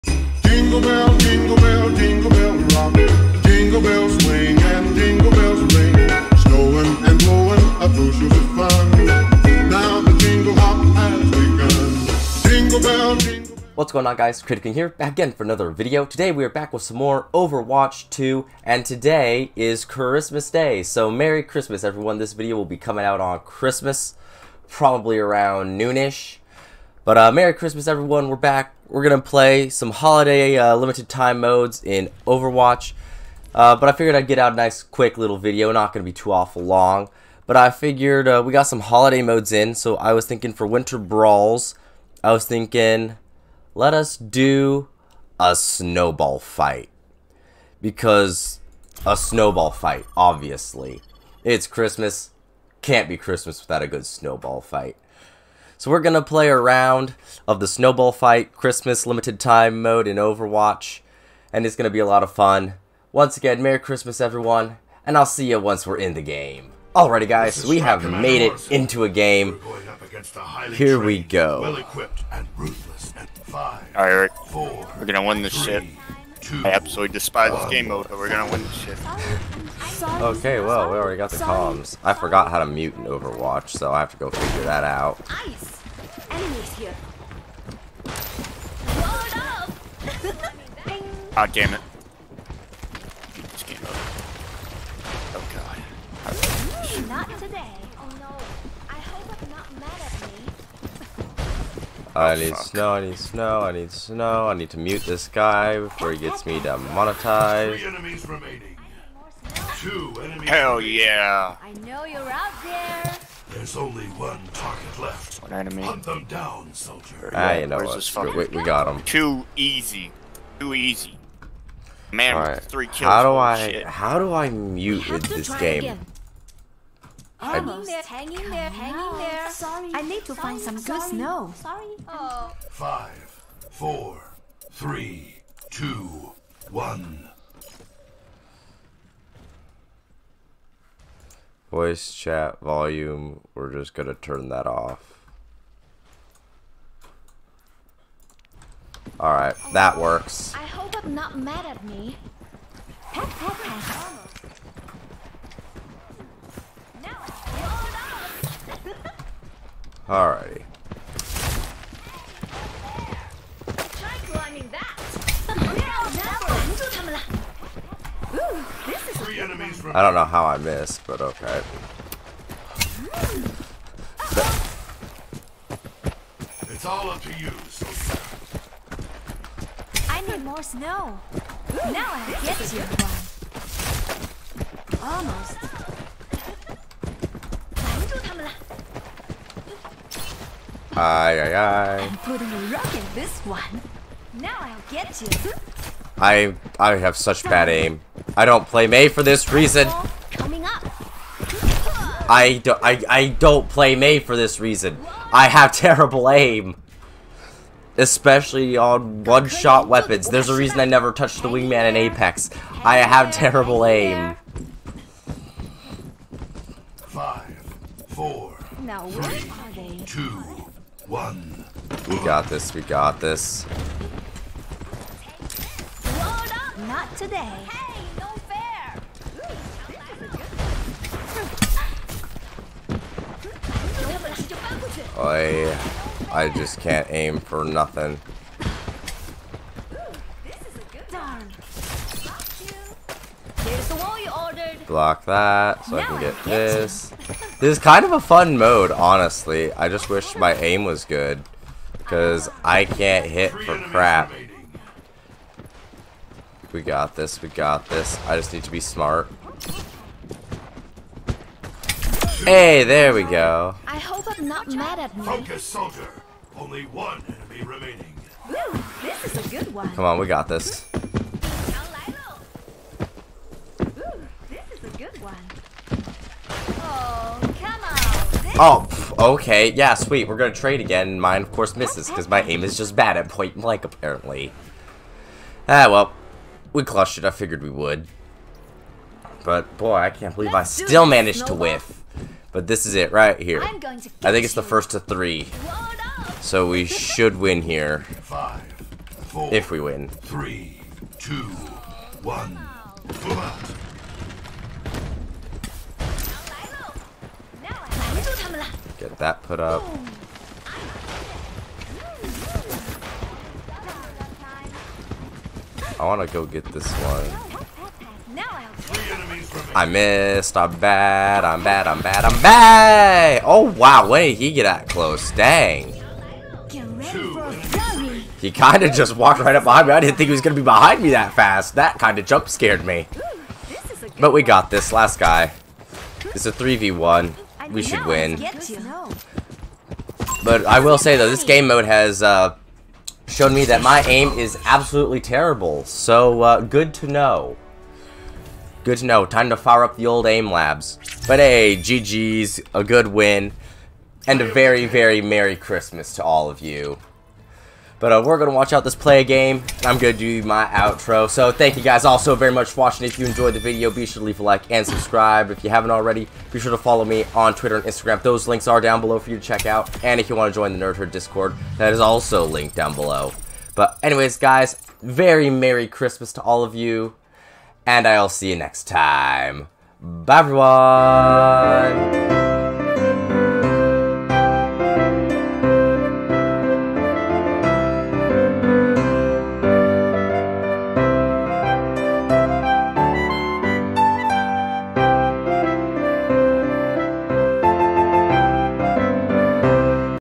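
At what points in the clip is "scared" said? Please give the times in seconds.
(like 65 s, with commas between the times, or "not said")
332 s.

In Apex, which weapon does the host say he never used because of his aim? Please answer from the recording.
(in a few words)
Wingman.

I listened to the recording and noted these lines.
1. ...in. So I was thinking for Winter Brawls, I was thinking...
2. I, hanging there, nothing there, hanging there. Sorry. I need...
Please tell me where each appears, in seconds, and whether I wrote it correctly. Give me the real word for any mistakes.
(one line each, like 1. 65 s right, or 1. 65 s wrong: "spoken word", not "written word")
1. 39 s right
2. 127 s wrong: "hanging", not "nothing".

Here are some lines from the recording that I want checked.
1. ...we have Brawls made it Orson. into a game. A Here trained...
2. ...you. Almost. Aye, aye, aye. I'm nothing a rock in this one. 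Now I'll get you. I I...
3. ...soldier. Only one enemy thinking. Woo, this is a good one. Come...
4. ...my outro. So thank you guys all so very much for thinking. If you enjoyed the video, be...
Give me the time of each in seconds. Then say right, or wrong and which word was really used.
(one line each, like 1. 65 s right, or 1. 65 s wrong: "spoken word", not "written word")
1. 67 s wrong: "Commander", not "Brawls"
2. 182 s wrong: "putting", not "nothing"
3. 265 s wrong: "remaining", not "thinking"
4. 360 s wrong: "watching", not "thinking".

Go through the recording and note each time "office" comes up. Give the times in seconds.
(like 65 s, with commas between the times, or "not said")
not said.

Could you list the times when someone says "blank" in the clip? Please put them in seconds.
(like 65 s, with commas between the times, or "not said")
283 s.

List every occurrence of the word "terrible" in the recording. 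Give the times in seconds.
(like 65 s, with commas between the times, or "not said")
205 s, 213 s, 345 s.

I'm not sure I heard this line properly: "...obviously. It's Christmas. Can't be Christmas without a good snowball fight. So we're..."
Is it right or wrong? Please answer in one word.
right.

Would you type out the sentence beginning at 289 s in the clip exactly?
But boy, I can't believe Let's I still managed Snowball.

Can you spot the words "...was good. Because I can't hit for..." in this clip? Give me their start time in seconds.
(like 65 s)
250 s.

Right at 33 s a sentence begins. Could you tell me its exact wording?
Uh, but I figured I'd get out a nice, quick little video.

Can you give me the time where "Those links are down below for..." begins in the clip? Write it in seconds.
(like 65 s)
368 s.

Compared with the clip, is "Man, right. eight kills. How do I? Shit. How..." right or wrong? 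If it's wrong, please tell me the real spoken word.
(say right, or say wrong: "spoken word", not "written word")
wrong: "three", not "eight".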